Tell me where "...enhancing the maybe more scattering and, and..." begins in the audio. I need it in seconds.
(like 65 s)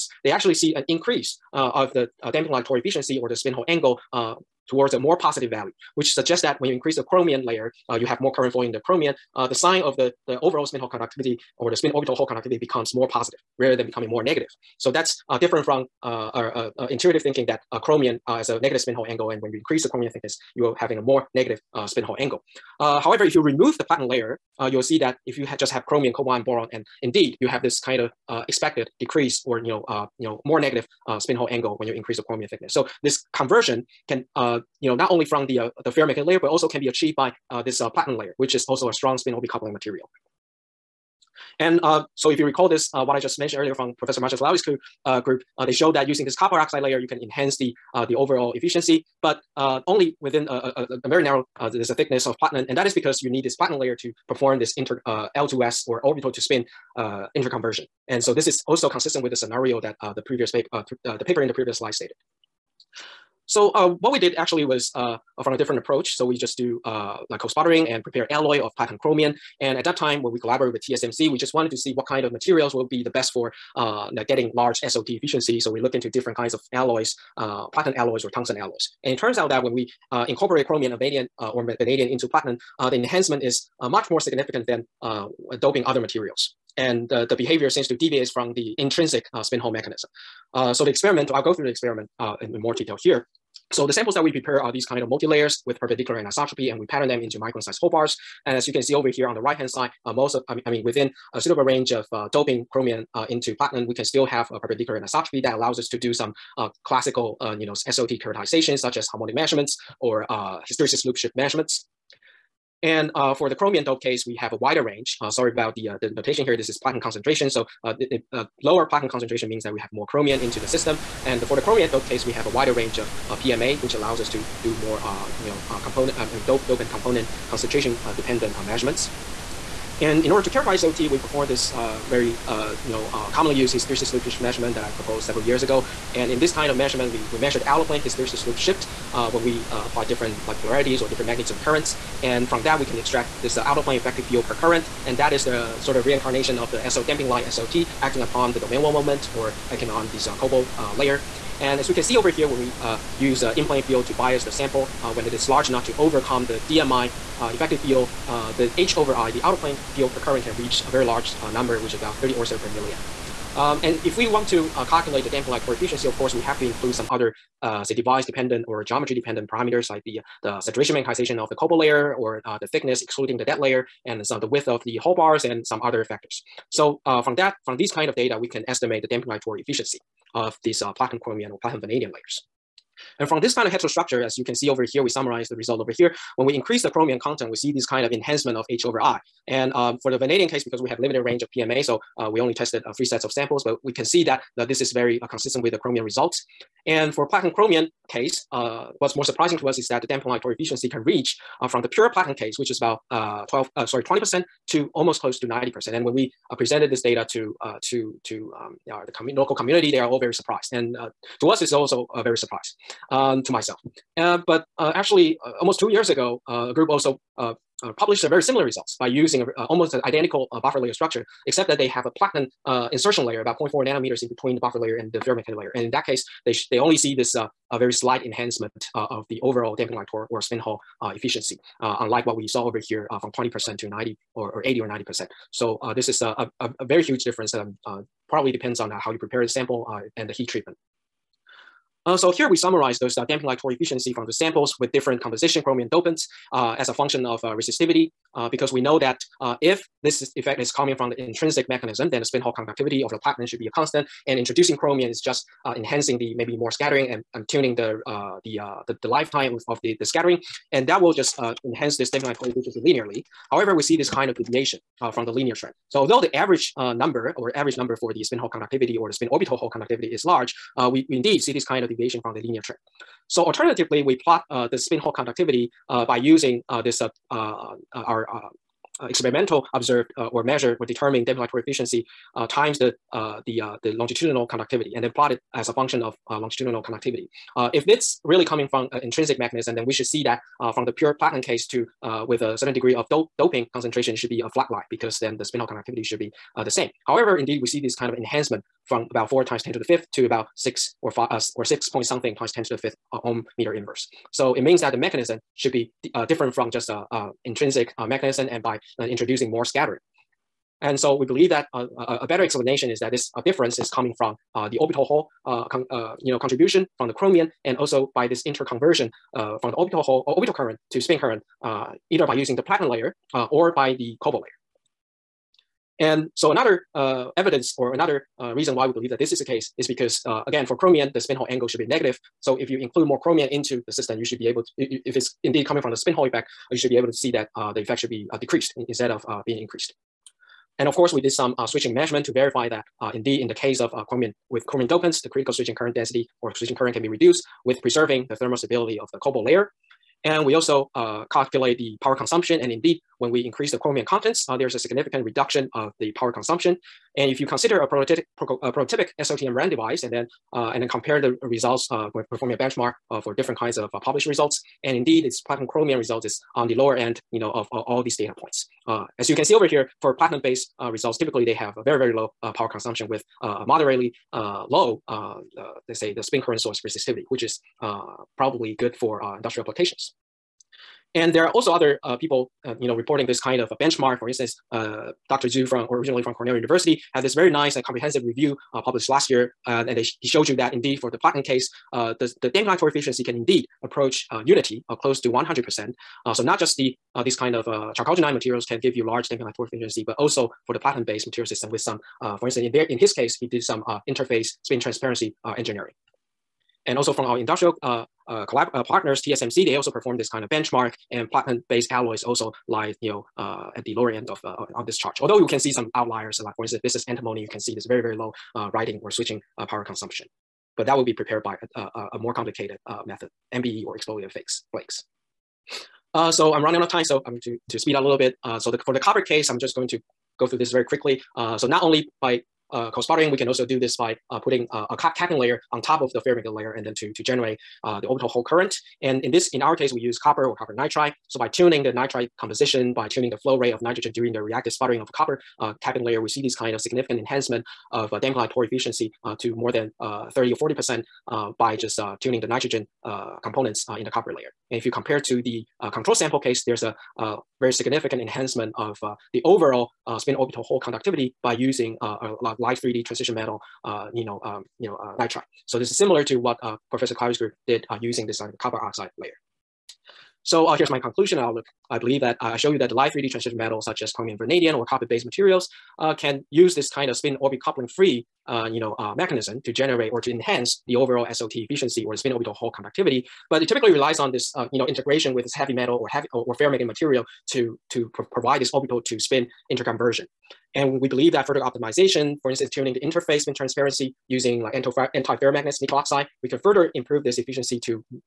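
255 s.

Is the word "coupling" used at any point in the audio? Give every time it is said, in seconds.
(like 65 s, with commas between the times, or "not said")
39 s, 477 s.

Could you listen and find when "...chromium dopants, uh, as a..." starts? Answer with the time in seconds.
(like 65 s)
245 s.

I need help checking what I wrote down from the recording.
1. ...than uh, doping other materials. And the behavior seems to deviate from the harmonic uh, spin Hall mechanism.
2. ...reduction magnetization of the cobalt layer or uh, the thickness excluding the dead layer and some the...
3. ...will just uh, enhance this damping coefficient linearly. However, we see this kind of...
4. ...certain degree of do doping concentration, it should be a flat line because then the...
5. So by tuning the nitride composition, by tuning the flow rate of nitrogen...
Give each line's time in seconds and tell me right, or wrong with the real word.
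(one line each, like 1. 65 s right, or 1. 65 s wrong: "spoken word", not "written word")
1. 84 s wrong: "intrinsic", not "harmonic"
2. 170 s wrong: "saturation", not "reduction"
3. 260 s right
4. 292 s right
5. 441 s right.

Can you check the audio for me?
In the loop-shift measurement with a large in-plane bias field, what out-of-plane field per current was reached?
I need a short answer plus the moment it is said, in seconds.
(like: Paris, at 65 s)
30 oersted per milliamp, at 162 s.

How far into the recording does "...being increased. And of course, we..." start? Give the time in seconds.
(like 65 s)
339 s.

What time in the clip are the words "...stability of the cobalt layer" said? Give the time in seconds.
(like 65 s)
348 s.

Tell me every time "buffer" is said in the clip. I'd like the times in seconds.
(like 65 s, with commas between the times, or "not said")
220 s, 224 s.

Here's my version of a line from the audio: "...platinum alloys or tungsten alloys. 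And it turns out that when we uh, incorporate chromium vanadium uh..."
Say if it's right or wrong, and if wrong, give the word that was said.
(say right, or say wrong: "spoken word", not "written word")
right.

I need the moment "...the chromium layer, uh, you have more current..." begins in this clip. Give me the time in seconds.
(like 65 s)
6 s.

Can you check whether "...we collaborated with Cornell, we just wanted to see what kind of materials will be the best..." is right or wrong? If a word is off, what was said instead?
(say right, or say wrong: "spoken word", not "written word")
wrong: "TSMC", not "Cornell".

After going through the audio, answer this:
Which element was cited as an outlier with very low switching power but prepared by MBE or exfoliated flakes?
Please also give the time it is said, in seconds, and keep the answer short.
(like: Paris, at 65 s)
Antimony, at 417 s.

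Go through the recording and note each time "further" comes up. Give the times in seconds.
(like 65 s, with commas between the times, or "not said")
491 s, 496 s.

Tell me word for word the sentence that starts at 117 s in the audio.
So uh, the, the uh, lower platinum concentration means that we have more chromium into the system.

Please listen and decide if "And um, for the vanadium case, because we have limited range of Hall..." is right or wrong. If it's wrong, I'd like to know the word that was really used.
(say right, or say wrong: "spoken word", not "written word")
wrong: "PMA", not "Hall".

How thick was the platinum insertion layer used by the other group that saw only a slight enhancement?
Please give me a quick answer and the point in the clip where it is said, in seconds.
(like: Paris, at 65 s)
0.4 nanometers, at 223 s.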